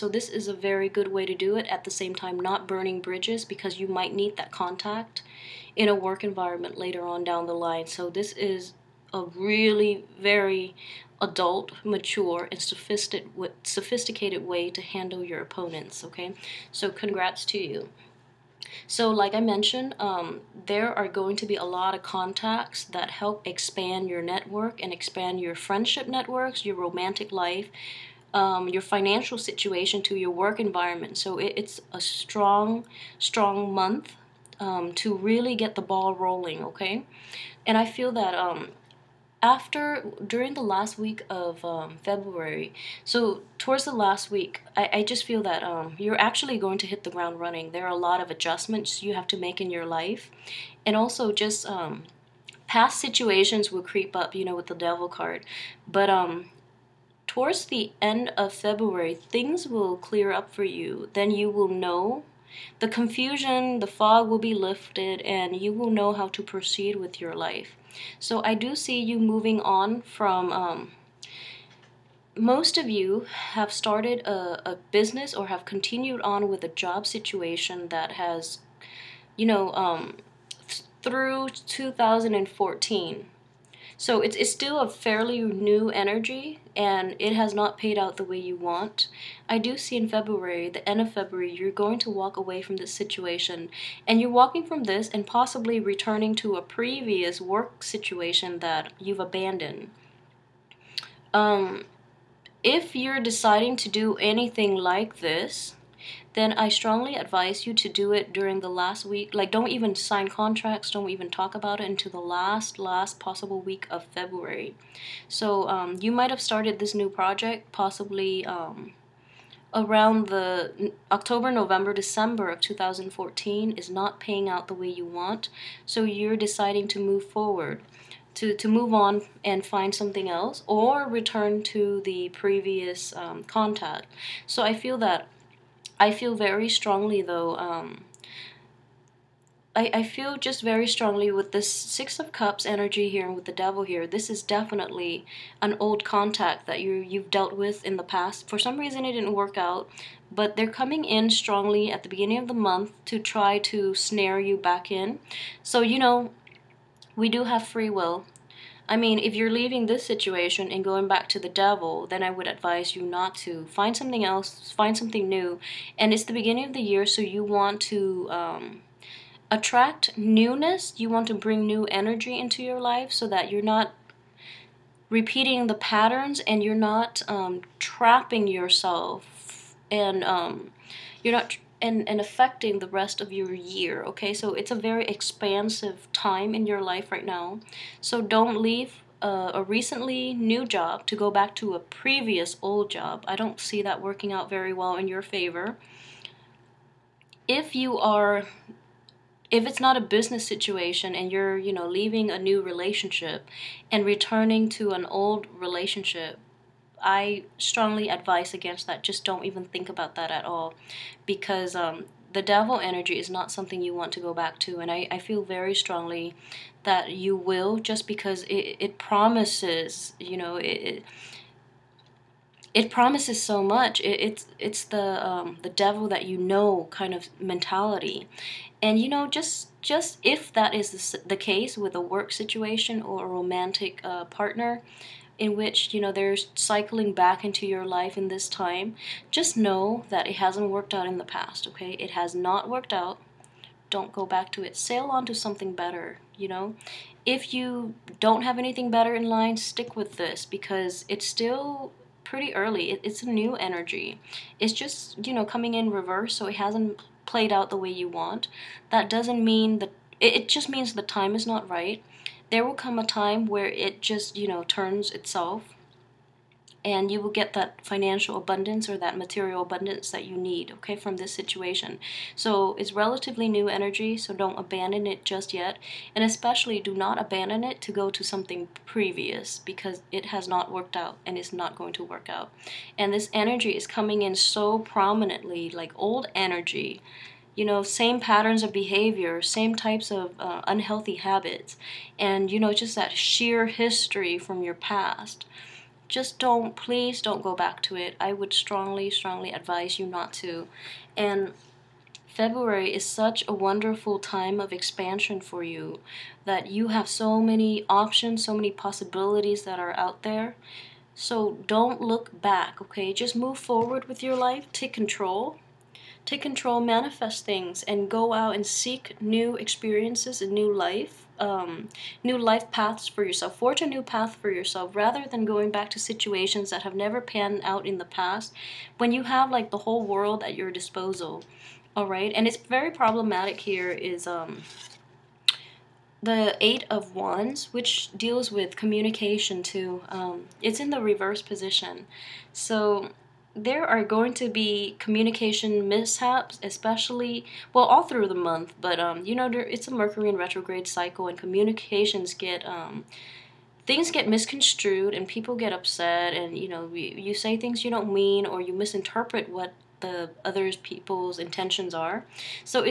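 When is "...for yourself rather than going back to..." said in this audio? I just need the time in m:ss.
5:24.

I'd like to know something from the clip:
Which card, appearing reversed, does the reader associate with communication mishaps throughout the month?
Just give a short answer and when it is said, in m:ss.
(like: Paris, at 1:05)
Eight of Wands, at 5:36.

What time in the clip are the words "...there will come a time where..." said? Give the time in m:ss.
4:22.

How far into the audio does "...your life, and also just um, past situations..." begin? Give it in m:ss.
0:49.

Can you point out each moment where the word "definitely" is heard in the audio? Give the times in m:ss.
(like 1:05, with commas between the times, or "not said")
2:24.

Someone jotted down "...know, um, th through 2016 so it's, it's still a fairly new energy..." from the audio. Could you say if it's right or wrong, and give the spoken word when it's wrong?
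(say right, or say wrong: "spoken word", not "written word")
wrong: "2014", not "2016".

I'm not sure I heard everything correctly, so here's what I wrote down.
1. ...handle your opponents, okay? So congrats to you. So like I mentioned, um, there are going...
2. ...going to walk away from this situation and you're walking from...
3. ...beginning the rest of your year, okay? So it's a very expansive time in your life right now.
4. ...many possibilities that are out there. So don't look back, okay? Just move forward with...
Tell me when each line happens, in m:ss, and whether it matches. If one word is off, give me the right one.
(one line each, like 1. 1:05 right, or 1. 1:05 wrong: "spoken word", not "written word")
1. 0:14 right
2. 1:31 right
3. 3:02 wrong: "affecting", not "beginning"
4. 5:08 right.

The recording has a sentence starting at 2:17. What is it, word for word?
Um, I, I feel just very strongly with this Six of Cups energy here and with the Devil here.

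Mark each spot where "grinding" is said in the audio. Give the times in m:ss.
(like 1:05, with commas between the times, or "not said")
not said.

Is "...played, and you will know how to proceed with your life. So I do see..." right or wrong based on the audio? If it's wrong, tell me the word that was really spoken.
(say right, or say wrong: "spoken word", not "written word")
wrong: "lifted", not "played".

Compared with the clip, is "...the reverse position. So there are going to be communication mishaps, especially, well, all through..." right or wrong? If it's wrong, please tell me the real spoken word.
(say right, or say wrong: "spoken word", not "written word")
right.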